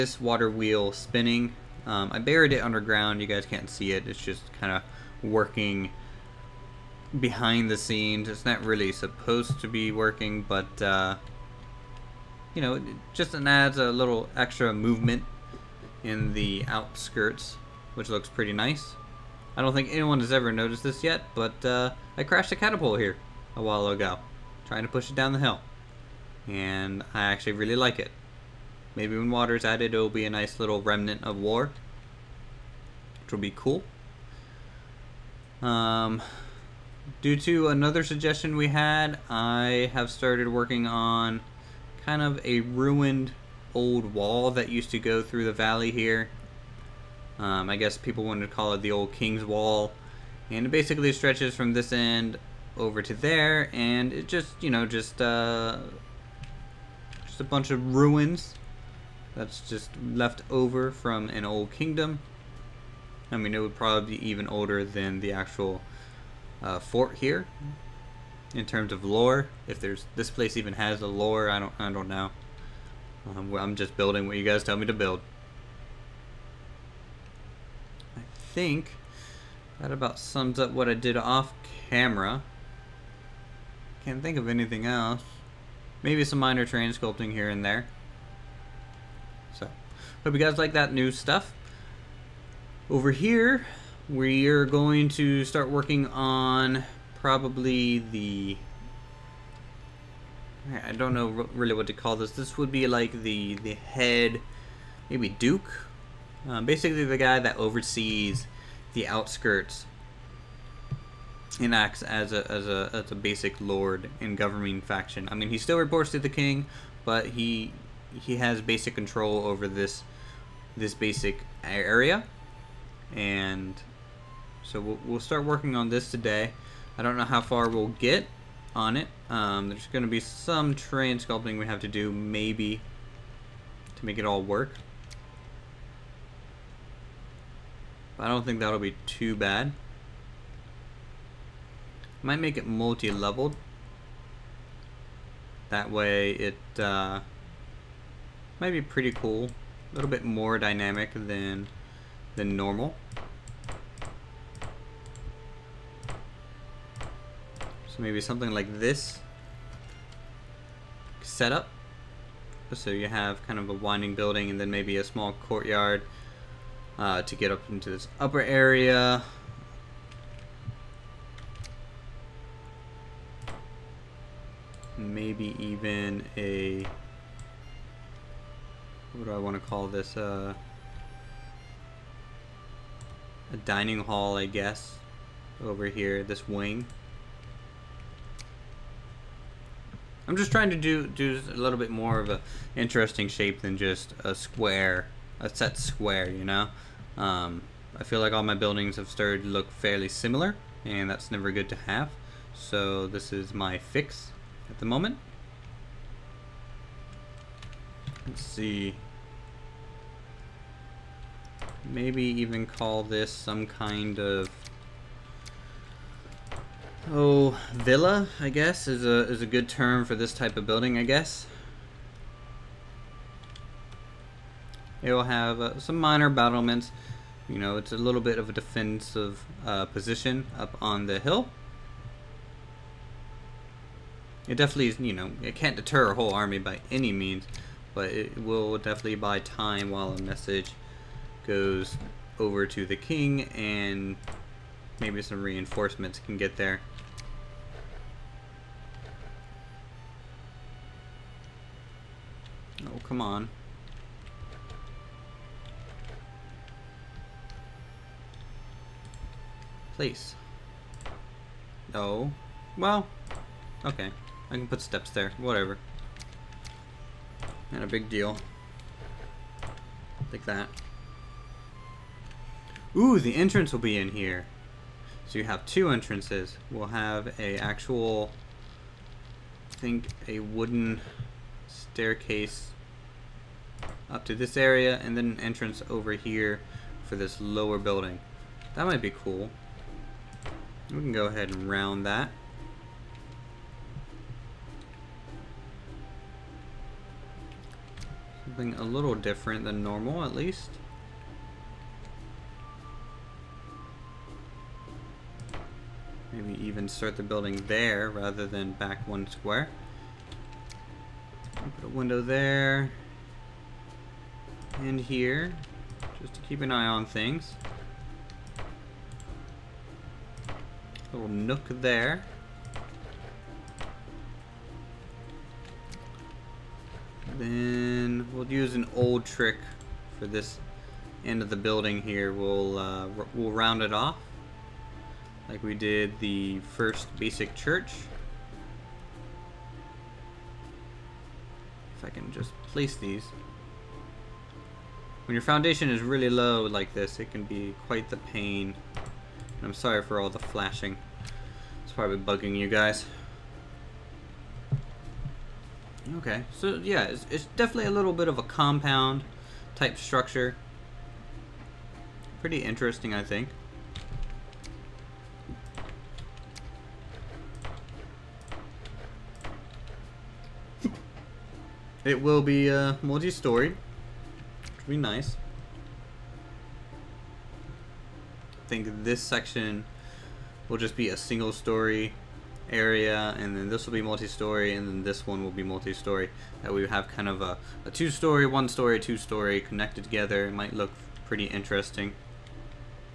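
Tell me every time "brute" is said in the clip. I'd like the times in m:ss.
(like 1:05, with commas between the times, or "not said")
not said.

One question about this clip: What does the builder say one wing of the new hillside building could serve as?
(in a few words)
a dining hall.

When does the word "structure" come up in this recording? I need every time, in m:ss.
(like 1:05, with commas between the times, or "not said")
5:59.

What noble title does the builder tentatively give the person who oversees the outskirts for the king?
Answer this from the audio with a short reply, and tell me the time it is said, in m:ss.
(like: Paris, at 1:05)
Duke, at 1:45.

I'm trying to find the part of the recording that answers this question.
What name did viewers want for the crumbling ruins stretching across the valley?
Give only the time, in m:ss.
0:48.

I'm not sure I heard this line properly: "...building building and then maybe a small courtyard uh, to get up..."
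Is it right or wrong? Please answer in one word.
wrong.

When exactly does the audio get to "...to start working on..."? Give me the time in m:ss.
1:35.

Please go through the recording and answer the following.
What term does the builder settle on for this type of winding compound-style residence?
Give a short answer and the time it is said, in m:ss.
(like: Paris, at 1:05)
villa, at 3:37.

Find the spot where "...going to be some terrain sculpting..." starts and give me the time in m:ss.
2:09.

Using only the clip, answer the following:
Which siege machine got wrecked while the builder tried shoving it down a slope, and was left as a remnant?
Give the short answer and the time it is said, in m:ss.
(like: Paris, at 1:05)
catapult, at 0:22.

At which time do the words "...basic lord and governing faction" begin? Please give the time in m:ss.
1:53.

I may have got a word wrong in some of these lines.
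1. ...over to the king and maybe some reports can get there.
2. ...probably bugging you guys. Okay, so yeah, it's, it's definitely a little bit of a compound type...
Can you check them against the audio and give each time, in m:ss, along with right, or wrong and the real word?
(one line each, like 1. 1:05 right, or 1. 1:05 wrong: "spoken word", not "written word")
1. 4:02 wrong: "reinforcements", not "reports"
2. 5:51 right.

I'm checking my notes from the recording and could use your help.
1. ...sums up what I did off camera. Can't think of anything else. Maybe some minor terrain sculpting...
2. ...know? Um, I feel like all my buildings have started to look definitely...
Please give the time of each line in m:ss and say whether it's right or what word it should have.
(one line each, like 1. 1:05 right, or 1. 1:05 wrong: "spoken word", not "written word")
1. 1:20 right
2. 3:16 wrong: "fairly", not "definitely".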